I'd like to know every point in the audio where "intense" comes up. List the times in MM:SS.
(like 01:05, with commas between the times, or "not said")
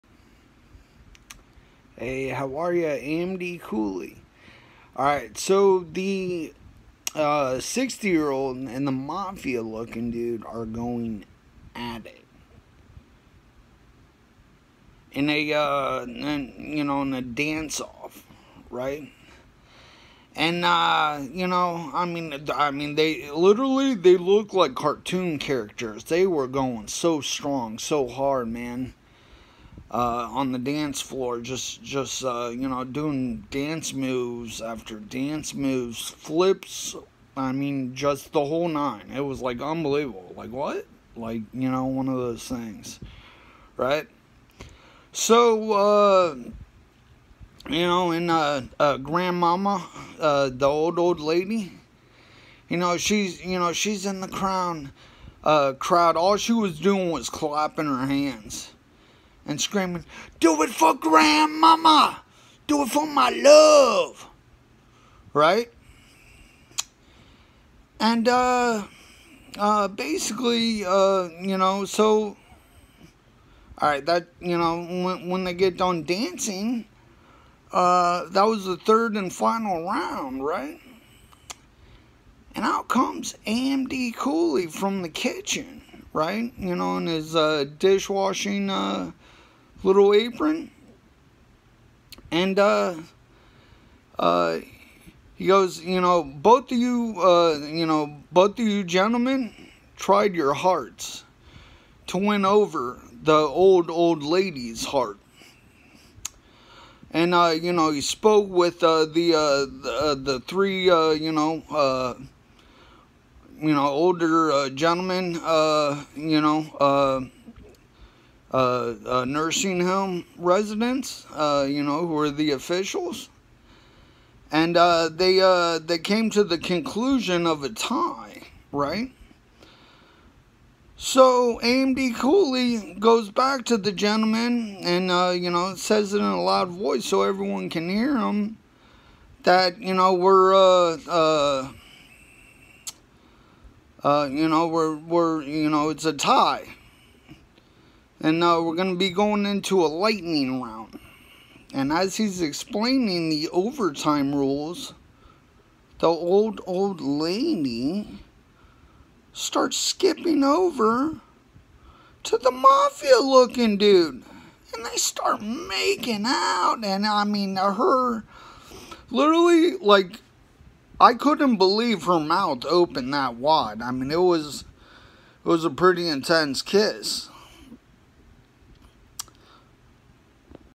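02:56.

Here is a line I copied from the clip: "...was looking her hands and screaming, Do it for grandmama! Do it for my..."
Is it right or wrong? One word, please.
wrong.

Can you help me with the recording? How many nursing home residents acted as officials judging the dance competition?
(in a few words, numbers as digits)
3.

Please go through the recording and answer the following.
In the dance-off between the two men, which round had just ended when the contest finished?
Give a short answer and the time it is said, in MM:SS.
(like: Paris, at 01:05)
third, at 01:18.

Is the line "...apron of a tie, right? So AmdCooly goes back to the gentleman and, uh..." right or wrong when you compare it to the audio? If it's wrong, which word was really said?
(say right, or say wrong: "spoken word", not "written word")
wrong: "conclusion", not "apron".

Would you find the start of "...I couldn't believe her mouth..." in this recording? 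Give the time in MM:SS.
02:50.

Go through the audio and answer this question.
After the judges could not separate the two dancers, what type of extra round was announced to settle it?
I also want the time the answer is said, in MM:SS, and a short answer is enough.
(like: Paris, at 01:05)
lightning round, at 02:29.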